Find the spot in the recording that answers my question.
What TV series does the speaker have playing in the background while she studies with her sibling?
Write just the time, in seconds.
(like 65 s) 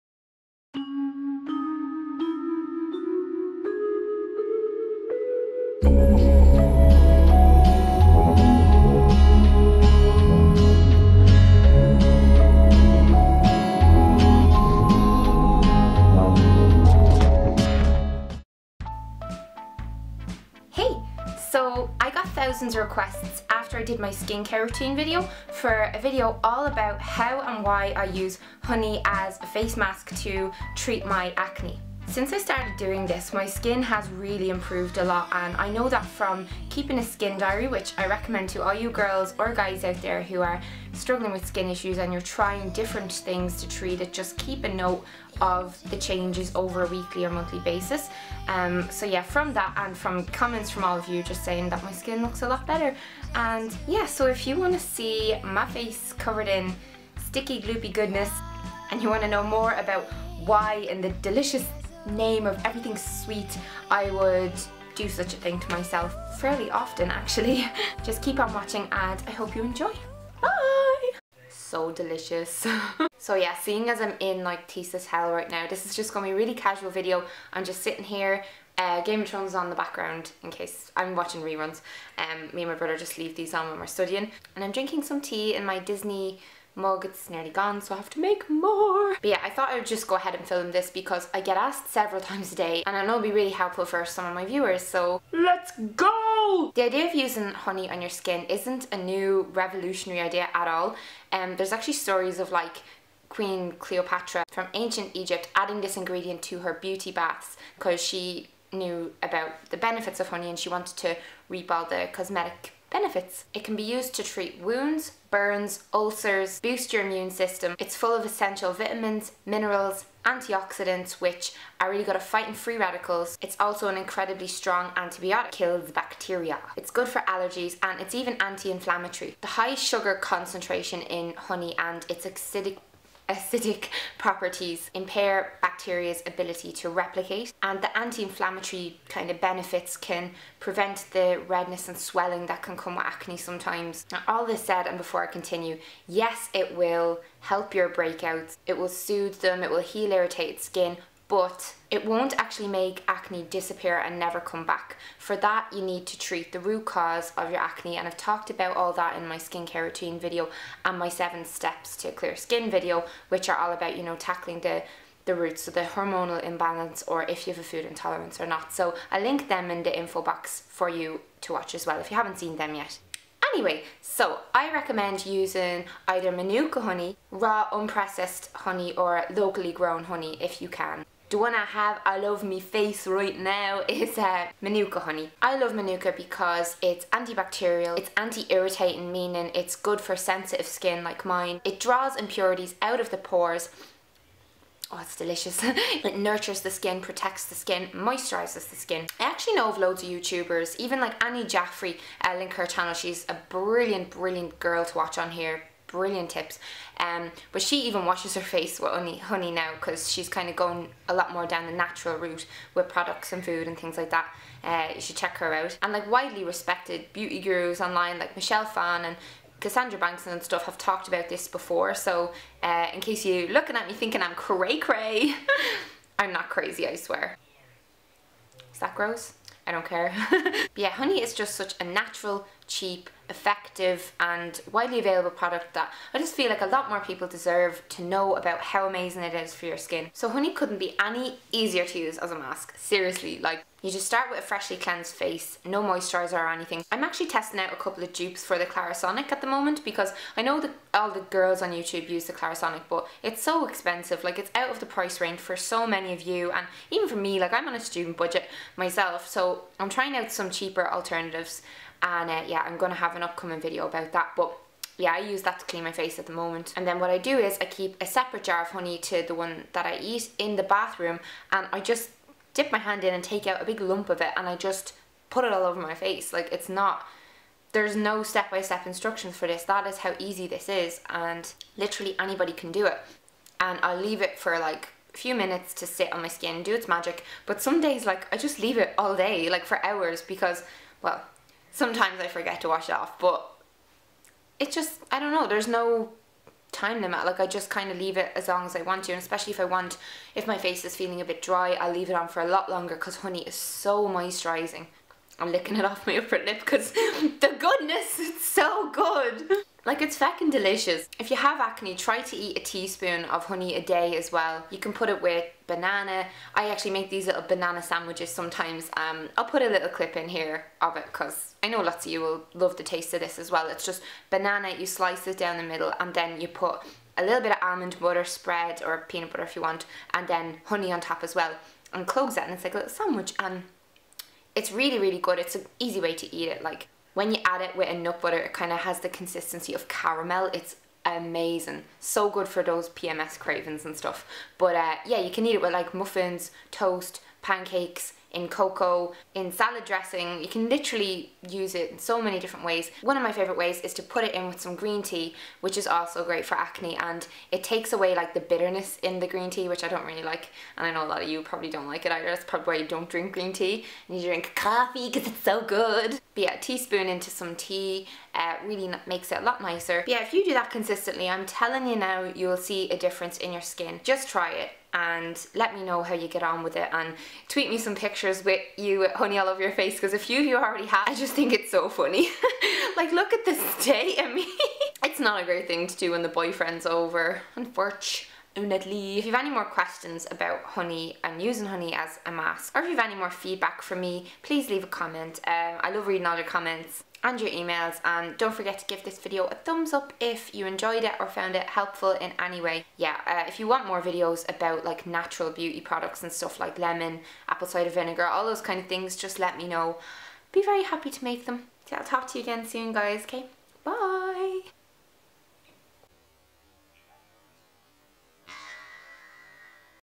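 79 s.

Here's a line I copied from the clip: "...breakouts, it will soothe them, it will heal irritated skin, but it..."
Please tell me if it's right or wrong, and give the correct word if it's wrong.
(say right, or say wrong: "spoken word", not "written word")
right.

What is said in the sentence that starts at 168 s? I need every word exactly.
So I link them in the info box for you to watch as well if you haven't seen them yet.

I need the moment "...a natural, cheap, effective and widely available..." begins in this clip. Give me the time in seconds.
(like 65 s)
231 s.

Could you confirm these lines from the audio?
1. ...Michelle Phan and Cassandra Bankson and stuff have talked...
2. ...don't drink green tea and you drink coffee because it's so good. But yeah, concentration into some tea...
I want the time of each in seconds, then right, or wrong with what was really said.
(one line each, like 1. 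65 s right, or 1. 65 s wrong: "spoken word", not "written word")
1. 218 s right
2. 362 s wrong: "teaspoon", not "concentration".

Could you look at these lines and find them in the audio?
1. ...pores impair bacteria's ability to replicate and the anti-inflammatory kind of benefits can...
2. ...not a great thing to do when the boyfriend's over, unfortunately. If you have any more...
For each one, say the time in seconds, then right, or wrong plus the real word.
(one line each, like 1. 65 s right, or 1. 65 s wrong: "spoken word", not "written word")
1. 134 s wrong: "properties", not "pores"
2. 385 s right.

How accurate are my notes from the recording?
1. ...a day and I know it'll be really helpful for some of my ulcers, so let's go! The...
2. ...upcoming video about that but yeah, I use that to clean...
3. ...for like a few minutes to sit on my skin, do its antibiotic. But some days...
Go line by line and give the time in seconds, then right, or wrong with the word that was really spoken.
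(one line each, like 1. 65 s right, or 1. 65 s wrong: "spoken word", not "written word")
1. 92 s wrong: "viewers", not "ulcers"
2. 263 s right
3. 284 s wrong: "magic", not "antibiotic".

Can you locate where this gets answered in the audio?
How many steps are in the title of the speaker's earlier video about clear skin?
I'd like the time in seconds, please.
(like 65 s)
161 s.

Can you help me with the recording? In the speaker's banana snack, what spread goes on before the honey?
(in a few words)
almond butter.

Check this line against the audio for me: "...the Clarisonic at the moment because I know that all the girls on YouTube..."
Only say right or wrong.
right.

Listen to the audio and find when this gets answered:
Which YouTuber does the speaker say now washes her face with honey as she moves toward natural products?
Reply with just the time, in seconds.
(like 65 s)
201 s.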